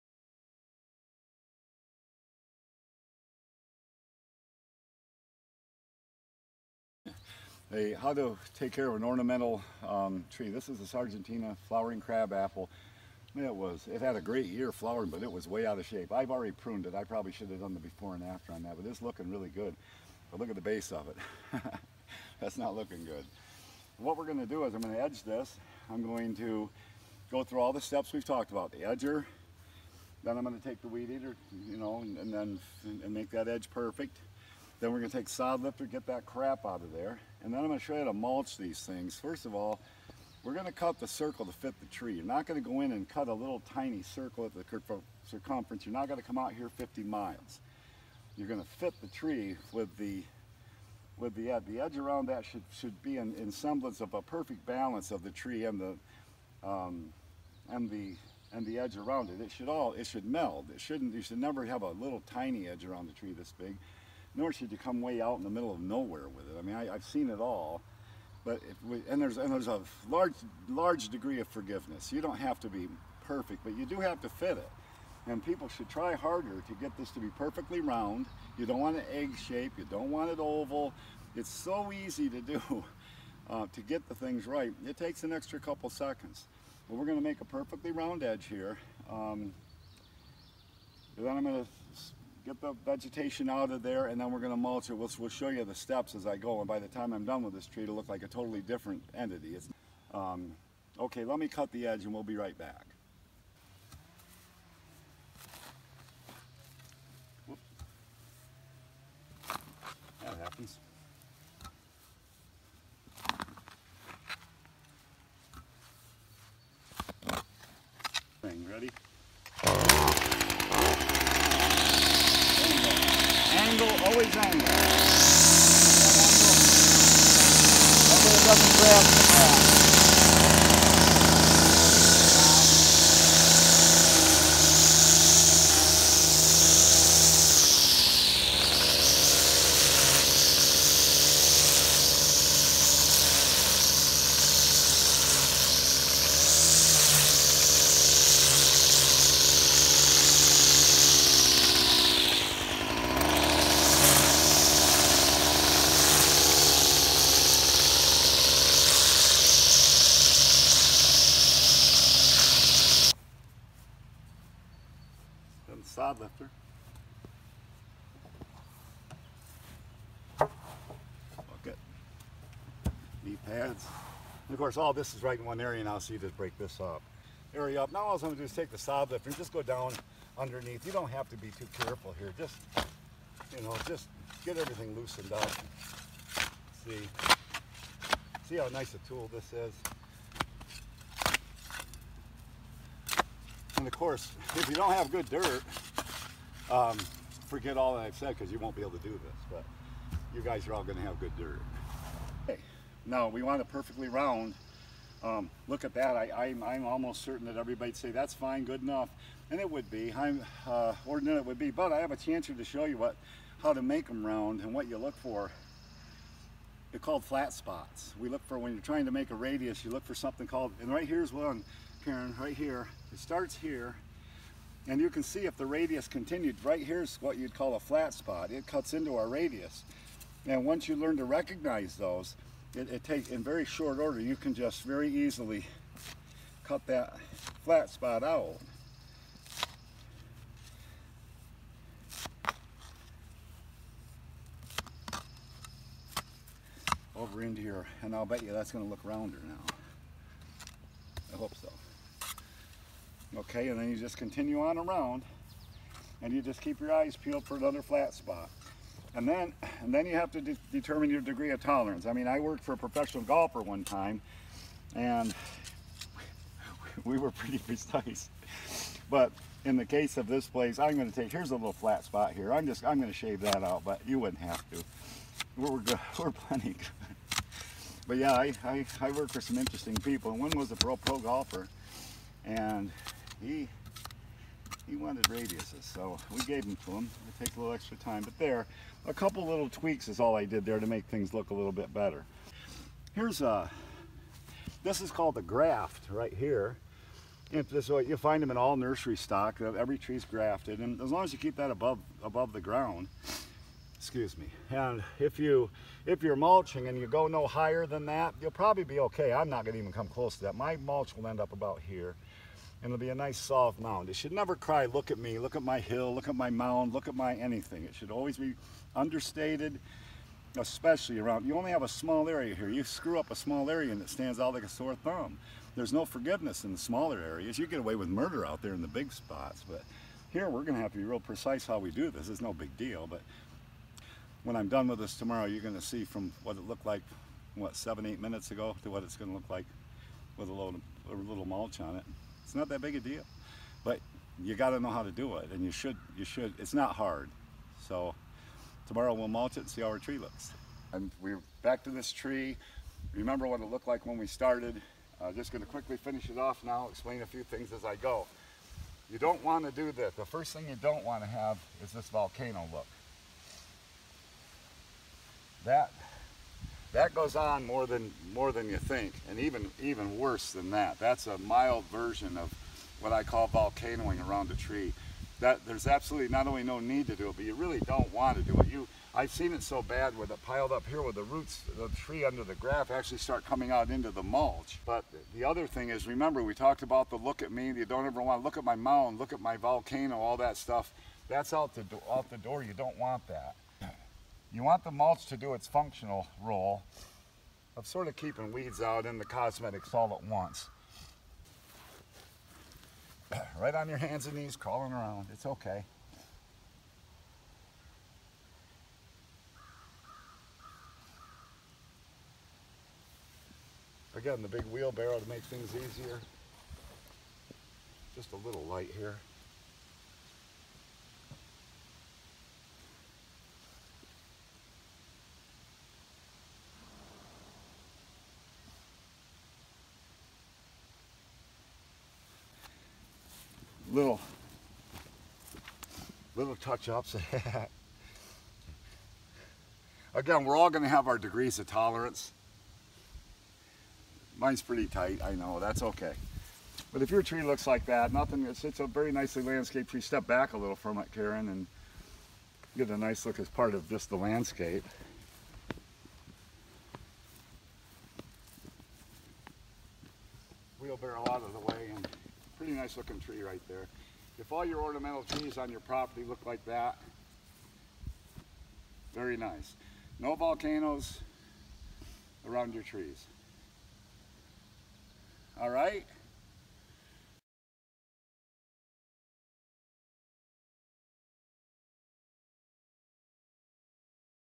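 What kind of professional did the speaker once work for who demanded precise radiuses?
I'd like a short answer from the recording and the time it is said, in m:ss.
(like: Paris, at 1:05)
professional golfer, at 4:22.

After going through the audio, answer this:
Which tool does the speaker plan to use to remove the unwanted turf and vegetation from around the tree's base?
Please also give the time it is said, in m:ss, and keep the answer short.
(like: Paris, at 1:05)
sod lifter, at 0:35.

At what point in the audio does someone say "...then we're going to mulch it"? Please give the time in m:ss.
1:34.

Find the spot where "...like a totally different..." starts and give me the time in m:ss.
1:38.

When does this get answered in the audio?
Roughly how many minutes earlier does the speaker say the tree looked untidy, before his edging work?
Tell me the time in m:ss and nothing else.
5:37.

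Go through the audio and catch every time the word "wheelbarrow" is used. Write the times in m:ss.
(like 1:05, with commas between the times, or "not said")
6:54, 7:40.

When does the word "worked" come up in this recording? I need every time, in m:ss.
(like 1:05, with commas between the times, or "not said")
4:22, 4:39.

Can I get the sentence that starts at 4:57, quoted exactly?
So uh, you find them in all nursery stock.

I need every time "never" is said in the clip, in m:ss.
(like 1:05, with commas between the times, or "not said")
1:01, 5:14.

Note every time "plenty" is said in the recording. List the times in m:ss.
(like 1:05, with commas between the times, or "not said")
4:36.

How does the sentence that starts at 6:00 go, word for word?
The first thing you don't want to have is this volcano look.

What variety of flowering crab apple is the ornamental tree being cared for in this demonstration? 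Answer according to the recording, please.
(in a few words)
Sargentina.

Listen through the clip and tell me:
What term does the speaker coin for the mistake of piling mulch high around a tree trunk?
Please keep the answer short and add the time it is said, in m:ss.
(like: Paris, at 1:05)
volcanoing, at 6:13.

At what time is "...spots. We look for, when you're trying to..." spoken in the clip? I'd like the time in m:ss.
3:37.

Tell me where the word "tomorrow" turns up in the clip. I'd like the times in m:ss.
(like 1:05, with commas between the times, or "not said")
5:35, 5:48.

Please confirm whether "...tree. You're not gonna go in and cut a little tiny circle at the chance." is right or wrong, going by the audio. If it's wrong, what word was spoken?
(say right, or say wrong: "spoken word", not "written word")
wrong: "circumference", not "chance".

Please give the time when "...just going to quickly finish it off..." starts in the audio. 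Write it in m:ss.
5:55.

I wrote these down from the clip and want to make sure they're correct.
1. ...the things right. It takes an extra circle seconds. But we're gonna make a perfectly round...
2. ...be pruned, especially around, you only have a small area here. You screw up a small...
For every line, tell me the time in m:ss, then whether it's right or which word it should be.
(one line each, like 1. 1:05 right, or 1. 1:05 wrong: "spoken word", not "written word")
1. 1:24 wrong: "couple", not "circle"
2. 5:18 wrong: "understated", not "pruned".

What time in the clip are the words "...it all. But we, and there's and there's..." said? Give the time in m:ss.
1:07.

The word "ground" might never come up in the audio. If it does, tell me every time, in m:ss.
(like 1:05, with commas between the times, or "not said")
2:09, 5:02.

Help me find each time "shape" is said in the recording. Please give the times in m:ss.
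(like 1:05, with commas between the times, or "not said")
0:15, 1:19.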